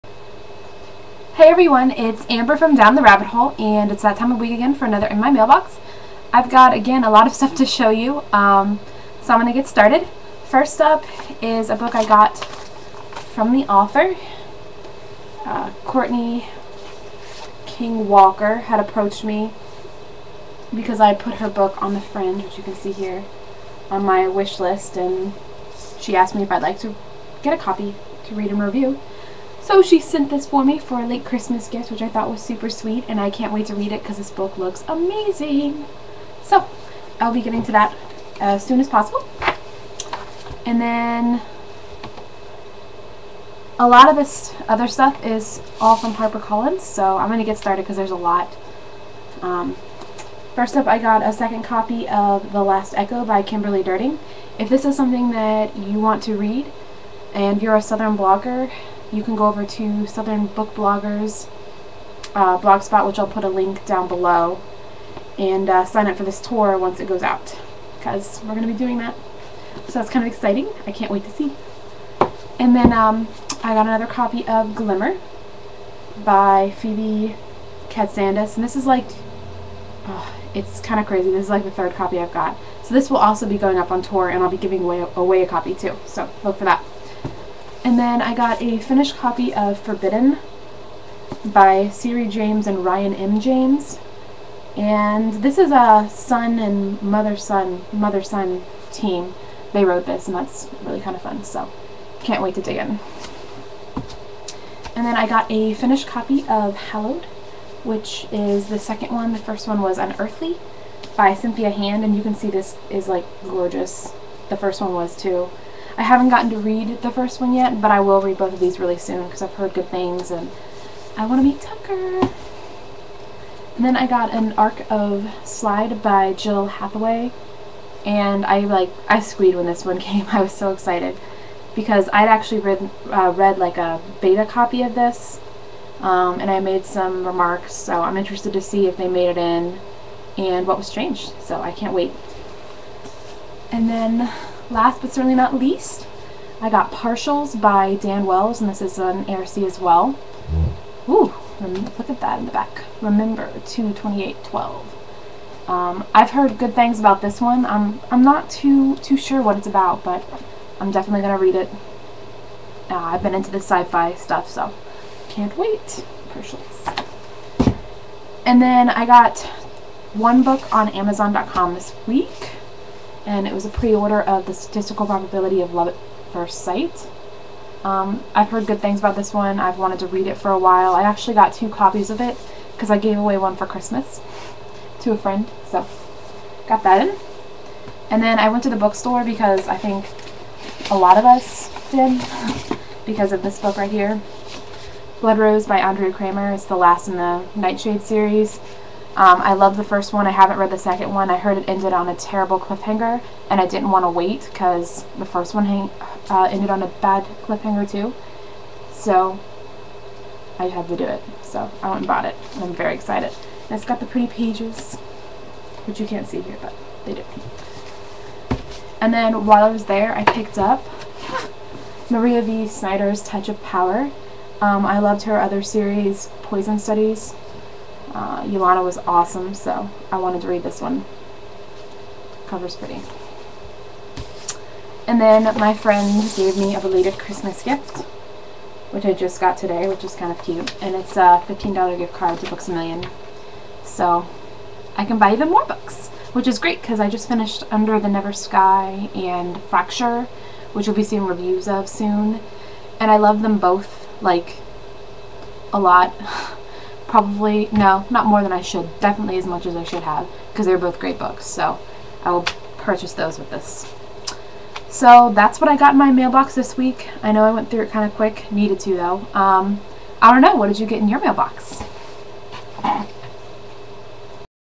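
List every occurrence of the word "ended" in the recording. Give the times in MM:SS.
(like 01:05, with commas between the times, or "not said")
03:21, 03:26.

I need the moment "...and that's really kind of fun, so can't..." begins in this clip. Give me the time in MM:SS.
01:40.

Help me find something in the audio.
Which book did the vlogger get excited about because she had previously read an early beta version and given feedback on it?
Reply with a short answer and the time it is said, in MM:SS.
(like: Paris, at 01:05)
Slide, at 02:05.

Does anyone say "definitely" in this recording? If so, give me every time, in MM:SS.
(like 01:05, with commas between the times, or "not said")
02:40, 04:19.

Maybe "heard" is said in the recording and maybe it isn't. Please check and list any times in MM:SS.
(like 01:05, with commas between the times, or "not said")
01:59, 02:36, 02:58, 03:21.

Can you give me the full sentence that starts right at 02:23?
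And then last but certainly not least, I got Partials by Dan Wells, and this is an ARC as well.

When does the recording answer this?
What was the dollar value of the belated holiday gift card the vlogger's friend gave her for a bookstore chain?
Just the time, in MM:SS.
04:01.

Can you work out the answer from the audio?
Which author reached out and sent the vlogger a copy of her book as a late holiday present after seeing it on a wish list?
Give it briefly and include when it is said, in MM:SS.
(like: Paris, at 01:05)
Courtney King Walker, at 00:15.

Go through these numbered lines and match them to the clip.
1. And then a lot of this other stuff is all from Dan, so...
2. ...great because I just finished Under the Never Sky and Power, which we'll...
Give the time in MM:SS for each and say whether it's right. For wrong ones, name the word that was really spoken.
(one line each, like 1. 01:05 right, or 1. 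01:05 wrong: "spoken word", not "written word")
1. 00:40 wrong: "HarperCollins", not "Dan"
2. 04:06 wrong: "Fracture", not "Power".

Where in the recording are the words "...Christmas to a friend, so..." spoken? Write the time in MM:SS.
03:03.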